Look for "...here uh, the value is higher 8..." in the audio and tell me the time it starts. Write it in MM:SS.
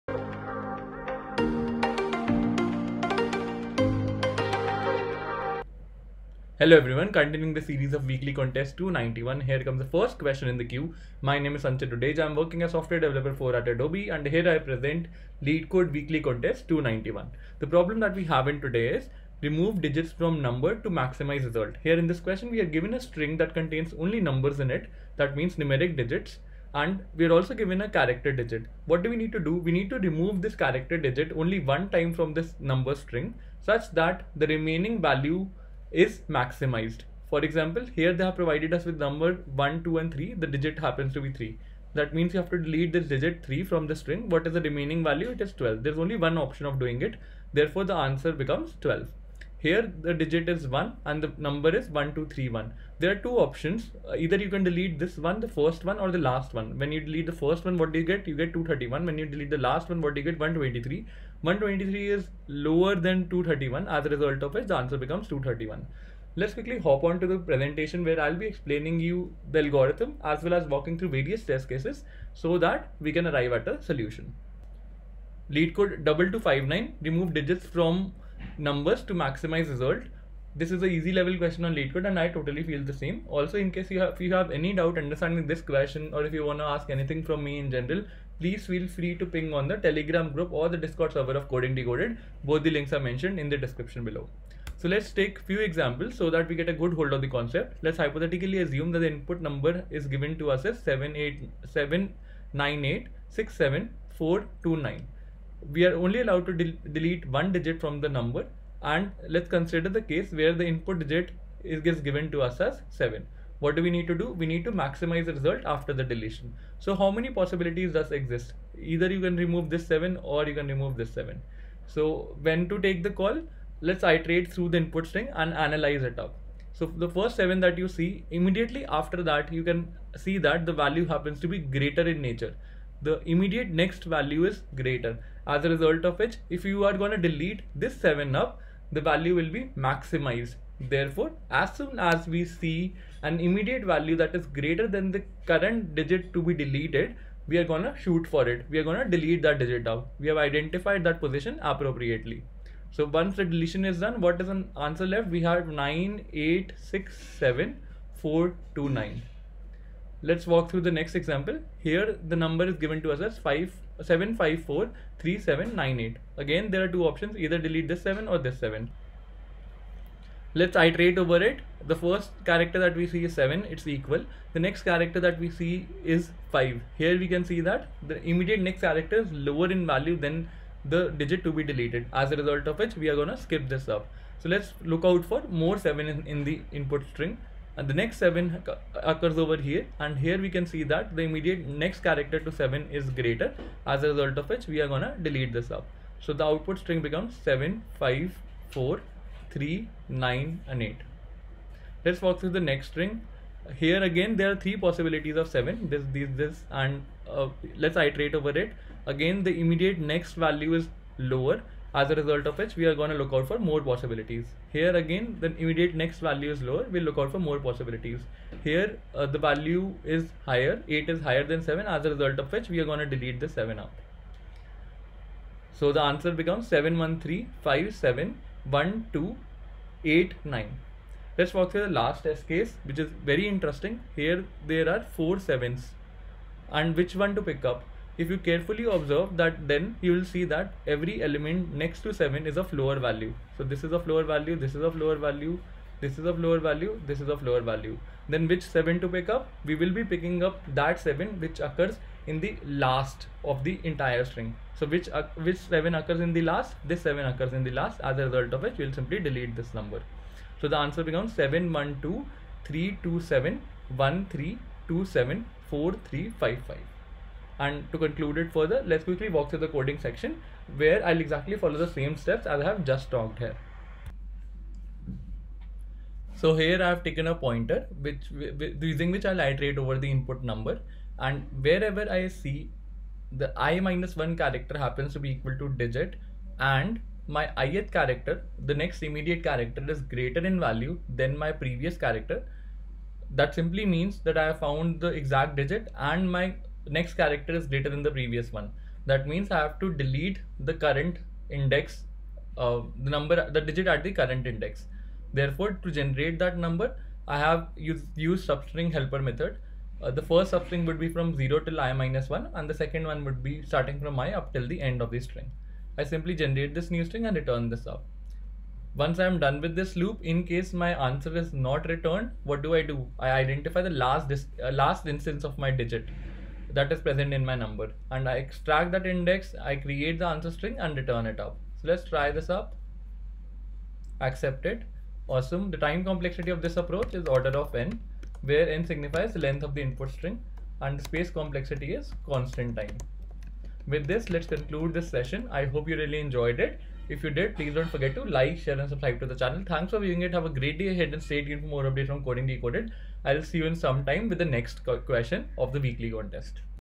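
03:38.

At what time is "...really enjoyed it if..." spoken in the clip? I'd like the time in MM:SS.
05:45.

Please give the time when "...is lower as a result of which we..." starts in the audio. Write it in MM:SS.
03:30.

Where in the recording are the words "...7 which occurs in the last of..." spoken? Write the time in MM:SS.
04:10.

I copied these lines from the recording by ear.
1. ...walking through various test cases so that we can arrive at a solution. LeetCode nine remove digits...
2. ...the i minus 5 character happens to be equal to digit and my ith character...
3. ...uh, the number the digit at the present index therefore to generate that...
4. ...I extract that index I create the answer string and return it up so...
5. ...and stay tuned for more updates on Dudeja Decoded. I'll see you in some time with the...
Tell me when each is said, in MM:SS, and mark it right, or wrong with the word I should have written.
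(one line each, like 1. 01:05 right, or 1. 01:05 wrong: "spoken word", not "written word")
1. 01:10 right
2. 04:43 wrong: "1", not "5"
3. 05:02 wrong: "current", not "present"
4. 05:28 right
5. 05:51 wrong: "Coding", not "Dudeja".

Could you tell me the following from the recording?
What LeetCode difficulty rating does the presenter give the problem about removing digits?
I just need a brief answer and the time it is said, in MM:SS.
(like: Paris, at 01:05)
Easy, at 01:20.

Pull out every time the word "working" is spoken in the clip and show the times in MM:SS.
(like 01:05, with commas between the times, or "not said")
00:12.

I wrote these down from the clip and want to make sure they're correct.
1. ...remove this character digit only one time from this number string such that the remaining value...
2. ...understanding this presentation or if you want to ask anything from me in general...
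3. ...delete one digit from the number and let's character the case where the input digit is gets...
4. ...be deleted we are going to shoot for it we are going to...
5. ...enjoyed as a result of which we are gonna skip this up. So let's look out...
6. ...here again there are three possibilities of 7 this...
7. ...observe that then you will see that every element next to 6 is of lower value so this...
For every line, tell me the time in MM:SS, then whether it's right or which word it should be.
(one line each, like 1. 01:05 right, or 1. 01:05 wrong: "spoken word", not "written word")
1. 00:29 right
2. 01:24 wrong: "question", not "presentation"
3. 01:46 wrong: "consider", not "character"
4. 02:26 right
5. 03:01 wrong: "deleted", not "enjoyed"
6. 03:23 right
7. 03:58 wrong: "7", not "6".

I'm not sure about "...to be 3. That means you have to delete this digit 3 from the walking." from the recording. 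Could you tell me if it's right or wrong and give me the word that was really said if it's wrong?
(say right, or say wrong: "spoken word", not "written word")
wrong: "string", not "walking".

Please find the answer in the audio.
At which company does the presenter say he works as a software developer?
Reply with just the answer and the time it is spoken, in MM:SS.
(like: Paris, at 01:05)
Adobe, at 00:13.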